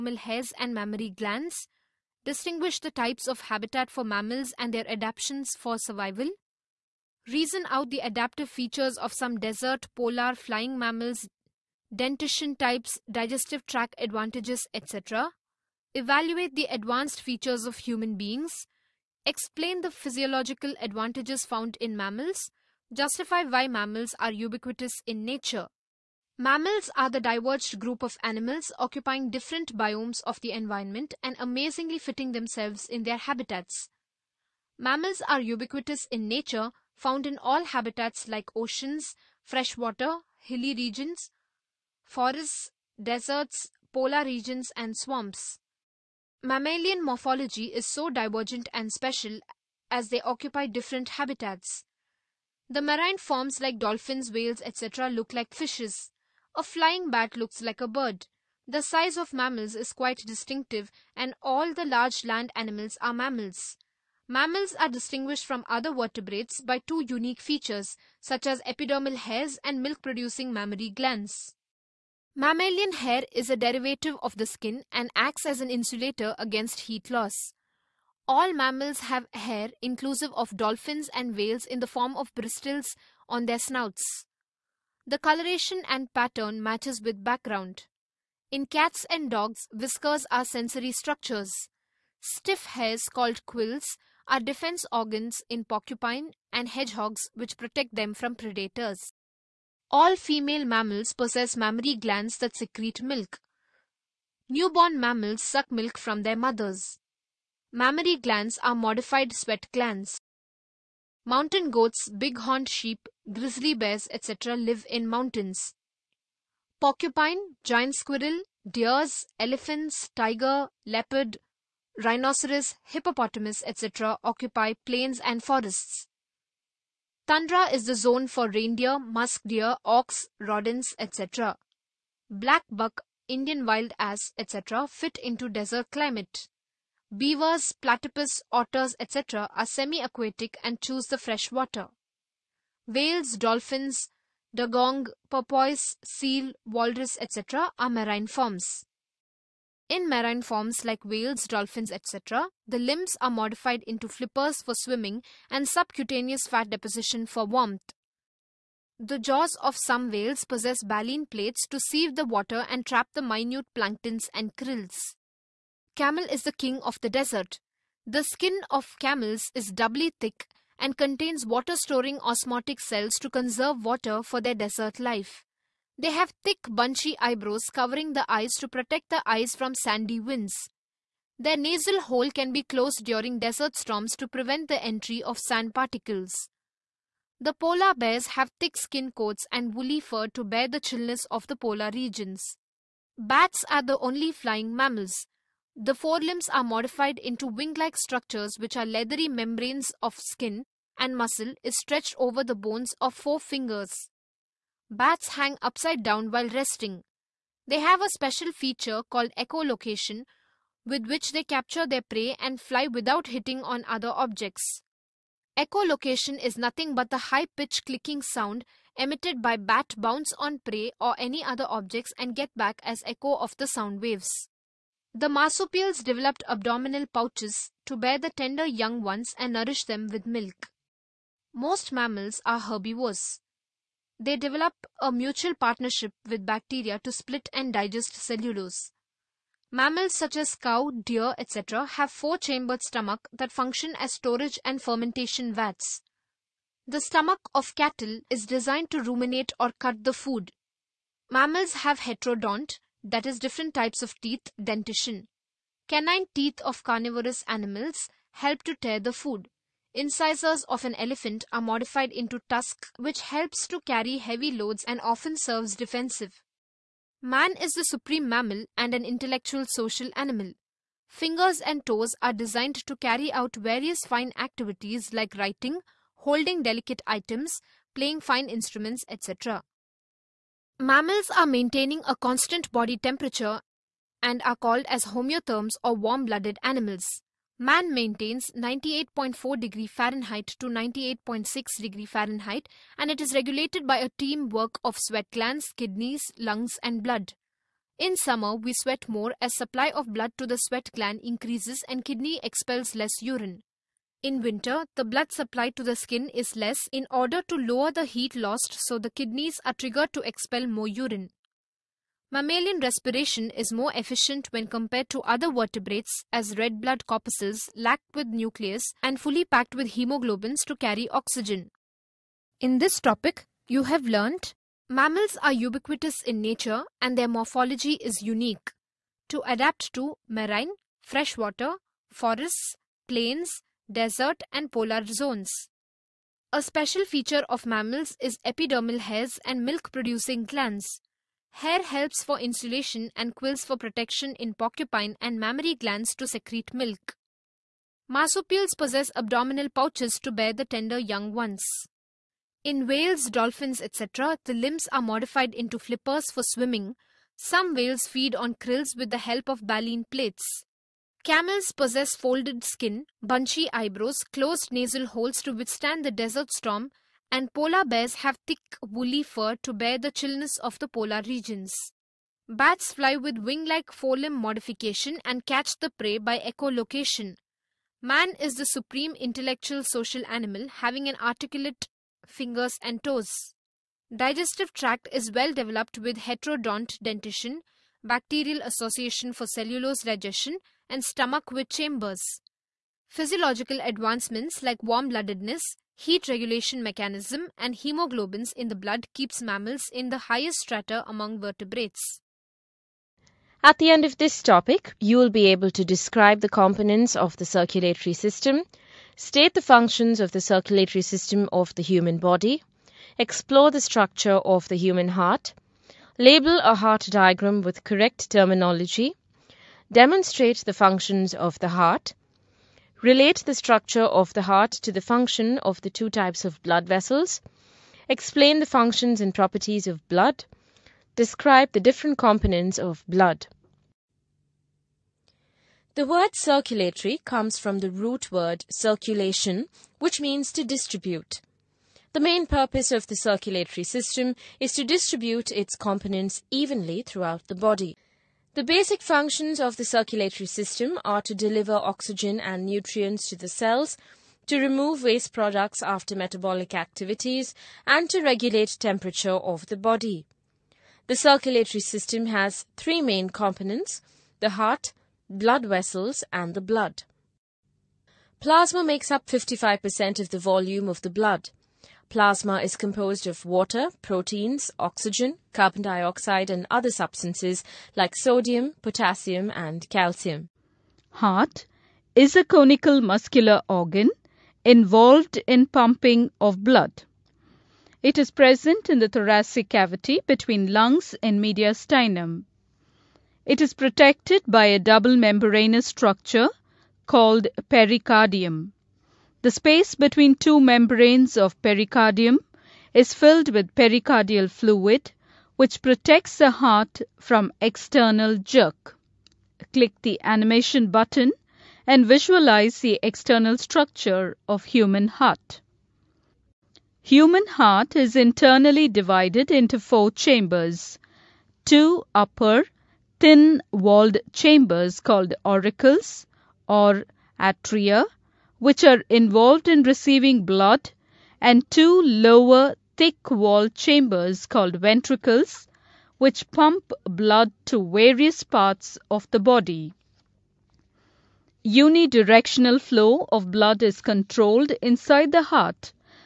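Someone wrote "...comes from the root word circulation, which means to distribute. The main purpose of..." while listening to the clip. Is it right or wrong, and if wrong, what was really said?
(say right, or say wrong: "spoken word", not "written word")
right.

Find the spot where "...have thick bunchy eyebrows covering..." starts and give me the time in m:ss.
2:56.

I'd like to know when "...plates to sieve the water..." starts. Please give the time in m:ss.
2:41.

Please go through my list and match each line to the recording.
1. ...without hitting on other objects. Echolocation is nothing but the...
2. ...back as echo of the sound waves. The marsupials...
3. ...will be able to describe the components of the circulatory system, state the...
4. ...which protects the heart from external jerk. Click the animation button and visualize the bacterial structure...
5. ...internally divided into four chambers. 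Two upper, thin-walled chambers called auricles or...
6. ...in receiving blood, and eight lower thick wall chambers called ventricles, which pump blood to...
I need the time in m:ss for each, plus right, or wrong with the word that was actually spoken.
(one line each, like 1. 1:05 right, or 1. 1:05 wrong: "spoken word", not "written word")
1. 3:32 right
2. 3:42 right
3. 6:45 right
4. 8:25 wrong: "external", not "bacterial"
5. 8:38 right
6. 8:49 wrong: "two", not "eight".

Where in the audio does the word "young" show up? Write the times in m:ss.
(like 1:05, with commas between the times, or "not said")
3:48, 5:50.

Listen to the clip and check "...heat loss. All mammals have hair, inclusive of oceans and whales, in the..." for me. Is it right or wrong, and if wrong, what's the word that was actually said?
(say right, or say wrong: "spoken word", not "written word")
wrong: "dolphins", not "oceans".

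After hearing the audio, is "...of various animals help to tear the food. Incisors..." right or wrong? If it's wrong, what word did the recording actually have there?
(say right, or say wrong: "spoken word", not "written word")
wrong: "carnivorous", not "various".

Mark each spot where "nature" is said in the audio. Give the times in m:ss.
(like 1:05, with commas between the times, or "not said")
0:25, 0:36, 5:26.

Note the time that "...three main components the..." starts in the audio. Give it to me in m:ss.
7:42.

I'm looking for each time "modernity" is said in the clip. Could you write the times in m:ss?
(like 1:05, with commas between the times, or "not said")
not said.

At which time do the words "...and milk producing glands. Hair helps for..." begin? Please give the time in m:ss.
5:39.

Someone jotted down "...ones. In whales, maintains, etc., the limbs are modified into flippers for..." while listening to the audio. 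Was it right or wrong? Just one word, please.
wrong.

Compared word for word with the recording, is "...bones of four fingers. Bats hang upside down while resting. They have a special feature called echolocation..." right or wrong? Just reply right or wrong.
right.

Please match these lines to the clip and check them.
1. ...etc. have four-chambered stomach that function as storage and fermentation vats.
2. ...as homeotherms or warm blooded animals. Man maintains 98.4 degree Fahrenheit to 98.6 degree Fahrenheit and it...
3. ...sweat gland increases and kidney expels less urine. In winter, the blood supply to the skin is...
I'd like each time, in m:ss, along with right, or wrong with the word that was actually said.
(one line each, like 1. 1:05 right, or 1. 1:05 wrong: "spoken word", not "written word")
1. 4:01 right
2. 4:44 right
3. 5:00 right.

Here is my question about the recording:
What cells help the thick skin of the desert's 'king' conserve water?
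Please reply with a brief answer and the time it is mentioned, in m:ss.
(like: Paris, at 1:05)
osmotic cells, at 2:52.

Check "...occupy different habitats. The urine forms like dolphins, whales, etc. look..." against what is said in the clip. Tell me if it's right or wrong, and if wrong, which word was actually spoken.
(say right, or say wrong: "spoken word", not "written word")
wrong: "marine", not "urine".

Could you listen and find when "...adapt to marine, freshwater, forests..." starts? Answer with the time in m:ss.
5:29.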